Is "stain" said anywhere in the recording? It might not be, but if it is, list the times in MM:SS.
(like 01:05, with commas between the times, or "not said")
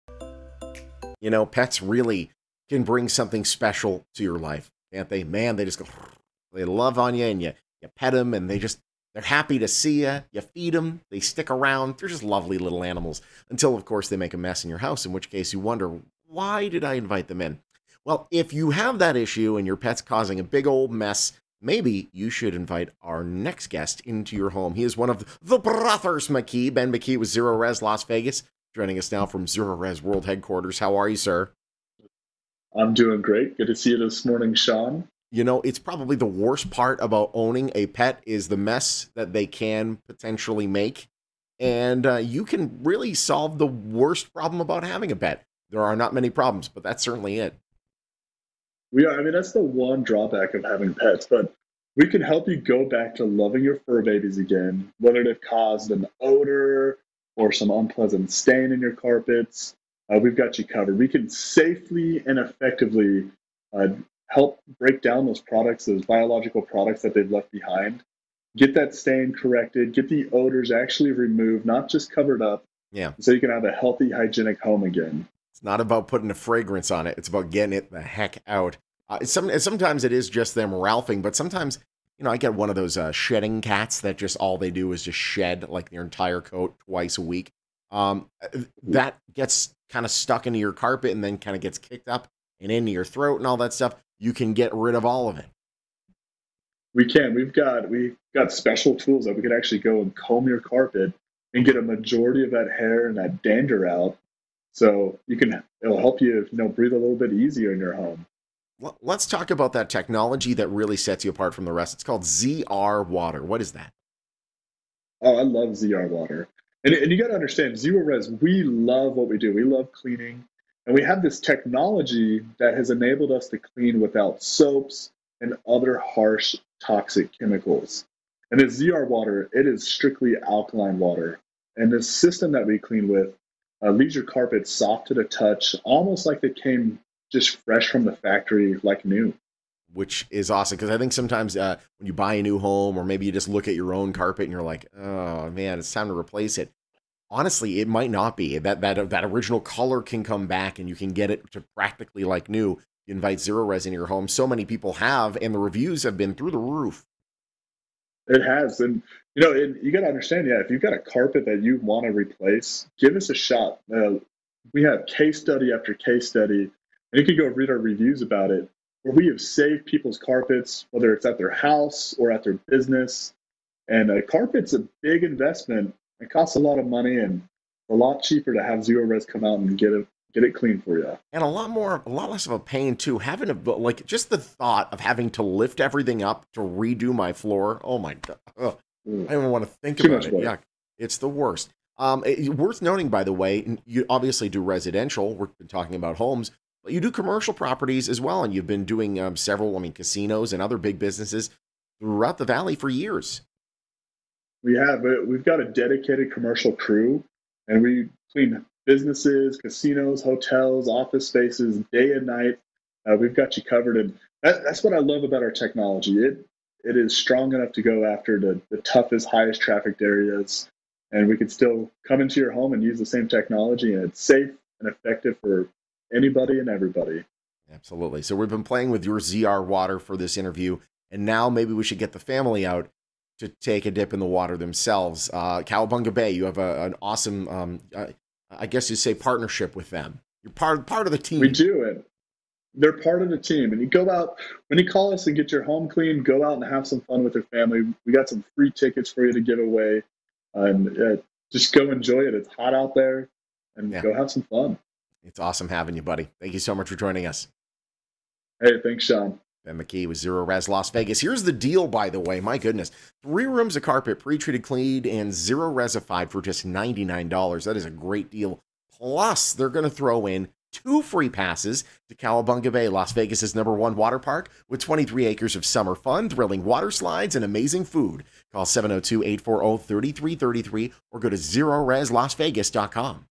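00:58, 01:08.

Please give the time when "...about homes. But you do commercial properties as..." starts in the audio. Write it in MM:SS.
03:15.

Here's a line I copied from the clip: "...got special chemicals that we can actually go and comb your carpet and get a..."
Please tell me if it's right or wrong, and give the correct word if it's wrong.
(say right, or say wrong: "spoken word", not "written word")
wrong: "tools", not "chemicals".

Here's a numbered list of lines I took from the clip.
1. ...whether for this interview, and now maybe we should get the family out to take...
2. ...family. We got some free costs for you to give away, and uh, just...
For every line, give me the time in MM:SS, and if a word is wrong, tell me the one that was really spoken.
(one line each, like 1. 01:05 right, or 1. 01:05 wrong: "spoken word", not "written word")
1. 03:49 wrong: "water", not "whether"
2. 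04:07 wrong: "tickets", not "costs".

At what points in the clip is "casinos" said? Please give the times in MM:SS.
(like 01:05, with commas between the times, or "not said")
03:19, 03:29.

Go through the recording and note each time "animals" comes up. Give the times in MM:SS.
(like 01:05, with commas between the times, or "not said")
00:12.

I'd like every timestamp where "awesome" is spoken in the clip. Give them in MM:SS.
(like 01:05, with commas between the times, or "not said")
02:20, 03:57, 04:15.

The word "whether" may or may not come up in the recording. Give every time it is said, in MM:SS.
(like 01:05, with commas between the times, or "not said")
00:54, 02:50.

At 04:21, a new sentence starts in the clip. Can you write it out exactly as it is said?
Here's the deal, by the way.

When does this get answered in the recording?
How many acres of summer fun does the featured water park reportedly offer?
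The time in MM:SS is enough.
04:34.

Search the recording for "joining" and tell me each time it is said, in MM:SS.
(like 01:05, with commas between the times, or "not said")
00:28, 04:16.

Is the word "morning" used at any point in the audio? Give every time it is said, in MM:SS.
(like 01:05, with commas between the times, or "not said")
00:34.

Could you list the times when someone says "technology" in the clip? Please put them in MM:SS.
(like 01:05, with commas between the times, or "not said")
01:49, 02:01, 03:35, 03:43.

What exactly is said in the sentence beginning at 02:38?
It has, and you know, and you got to understand, yeah.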